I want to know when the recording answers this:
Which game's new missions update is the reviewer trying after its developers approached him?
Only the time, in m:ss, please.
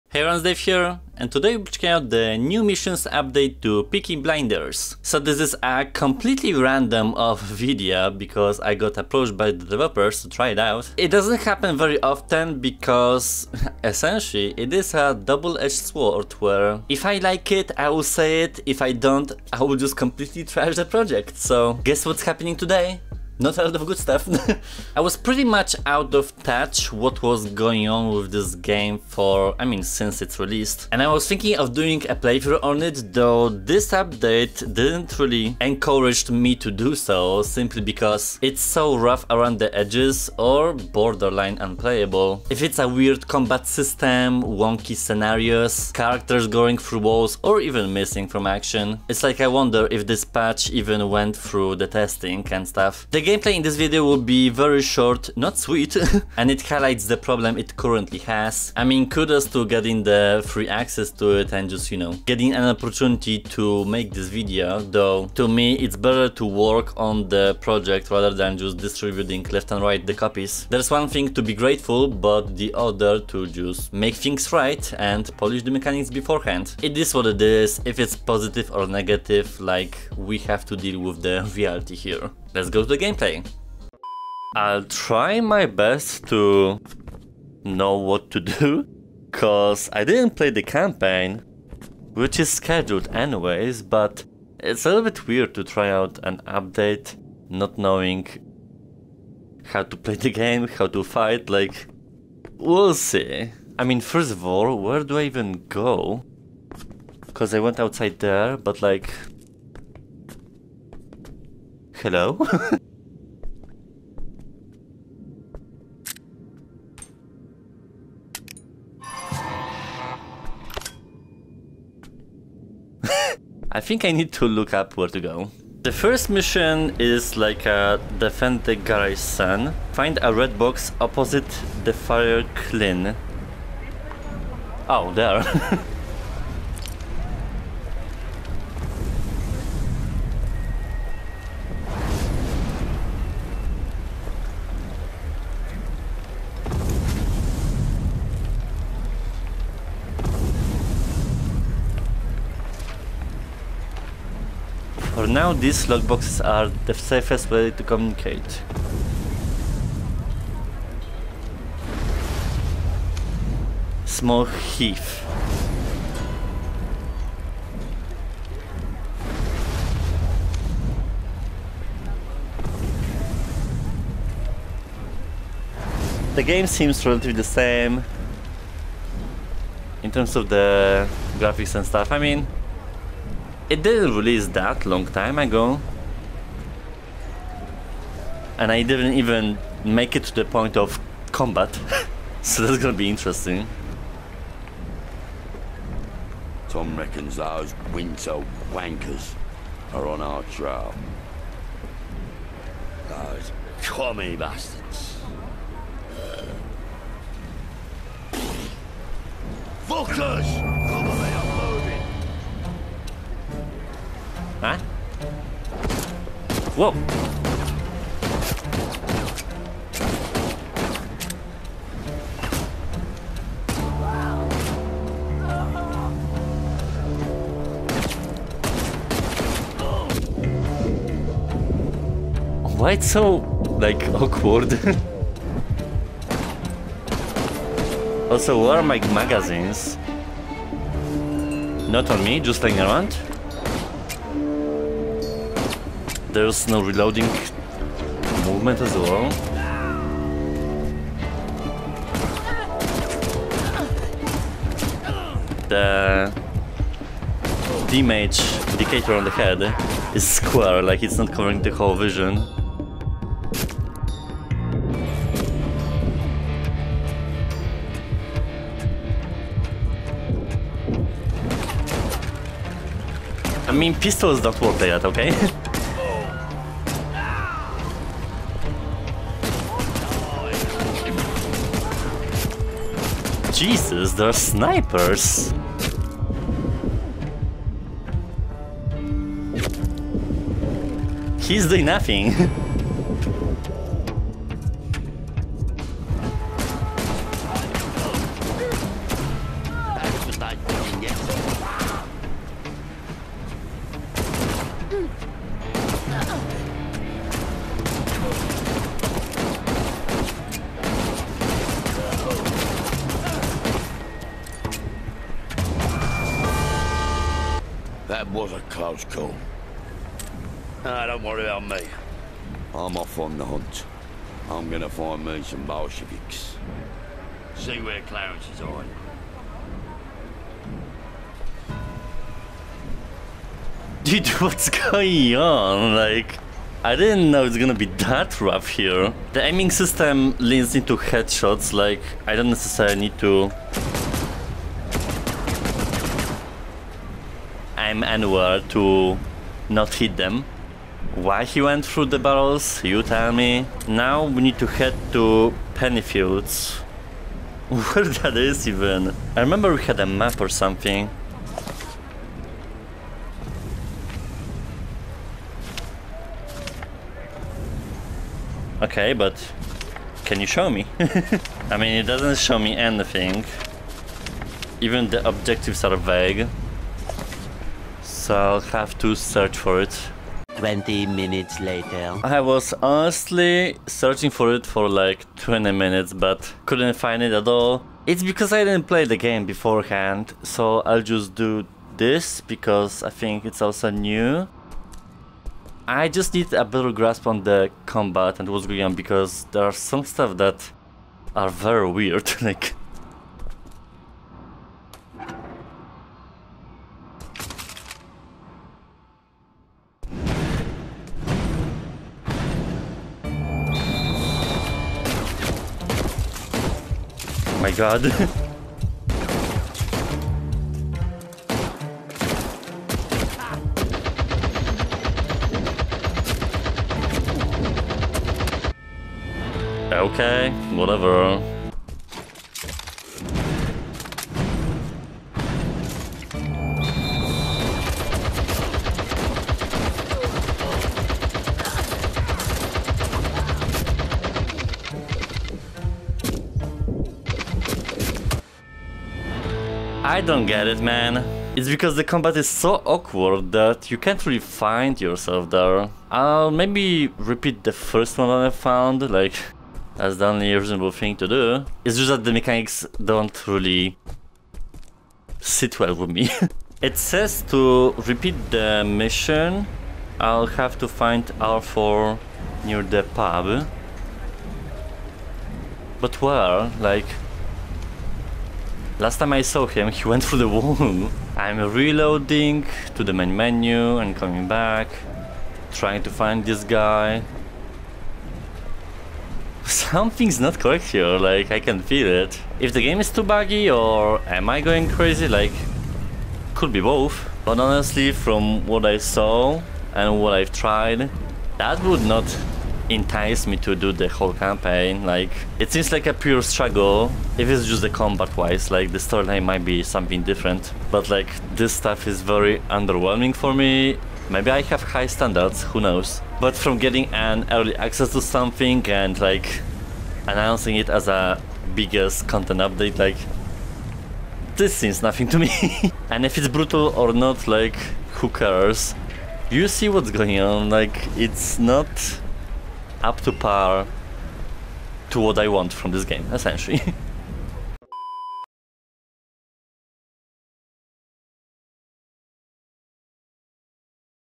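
0:03.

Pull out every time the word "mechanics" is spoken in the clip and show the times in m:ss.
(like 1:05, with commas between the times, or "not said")
1:15, 7:42.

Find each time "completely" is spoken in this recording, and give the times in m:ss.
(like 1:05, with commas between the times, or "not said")
0:05, 0:19.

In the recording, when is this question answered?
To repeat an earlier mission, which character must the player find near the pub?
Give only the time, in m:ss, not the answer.
7:51.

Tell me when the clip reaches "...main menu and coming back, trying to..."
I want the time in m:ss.
8:03.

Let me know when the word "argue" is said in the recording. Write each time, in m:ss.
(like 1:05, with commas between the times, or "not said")
not said.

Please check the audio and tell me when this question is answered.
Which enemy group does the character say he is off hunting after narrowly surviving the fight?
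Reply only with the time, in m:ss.
5:25.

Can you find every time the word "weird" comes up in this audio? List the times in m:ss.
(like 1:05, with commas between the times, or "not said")
0:42, 1:35, 6:41.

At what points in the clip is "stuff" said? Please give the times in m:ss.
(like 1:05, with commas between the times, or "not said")
0:23, 0:52, 3:01, 6:40, 8:31.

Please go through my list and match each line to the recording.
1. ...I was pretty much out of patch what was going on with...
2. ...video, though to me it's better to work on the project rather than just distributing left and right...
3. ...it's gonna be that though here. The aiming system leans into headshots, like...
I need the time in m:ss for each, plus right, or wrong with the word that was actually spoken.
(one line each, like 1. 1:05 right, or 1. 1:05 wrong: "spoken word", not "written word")
1. 0:24 wrong: "touch", not "patch"
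2. 1:04 right
3. 5:37 wrong: "rough", not "though".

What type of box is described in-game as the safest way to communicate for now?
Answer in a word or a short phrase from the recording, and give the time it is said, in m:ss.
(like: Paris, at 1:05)
Lockboxes, at 2:35.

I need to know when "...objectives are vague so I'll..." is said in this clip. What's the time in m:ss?
6:15.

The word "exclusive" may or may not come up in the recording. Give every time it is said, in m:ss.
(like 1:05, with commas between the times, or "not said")
not said.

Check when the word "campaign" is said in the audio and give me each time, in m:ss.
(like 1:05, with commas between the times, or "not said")
1:30, 8:24.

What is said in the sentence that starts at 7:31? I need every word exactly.
It's because the combat is so awkward that you can't really find yourself there.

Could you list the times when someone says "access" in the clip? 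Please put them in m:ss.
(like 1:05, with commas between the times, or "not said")
1:00, 8:37.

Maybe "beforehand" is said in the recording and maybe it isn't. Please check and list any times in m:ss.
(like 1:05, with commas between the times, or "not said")
1:16, 6:29.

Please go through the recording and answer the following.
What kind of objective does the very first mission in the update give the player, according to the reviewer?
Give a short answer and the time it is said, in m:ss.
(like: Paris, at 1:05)
Defend the garage, at 2:08.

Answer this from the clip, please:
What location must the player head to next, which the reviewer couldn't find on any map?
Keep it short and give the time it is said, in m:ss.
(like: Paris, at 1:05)
Pennyfields, at 5:55.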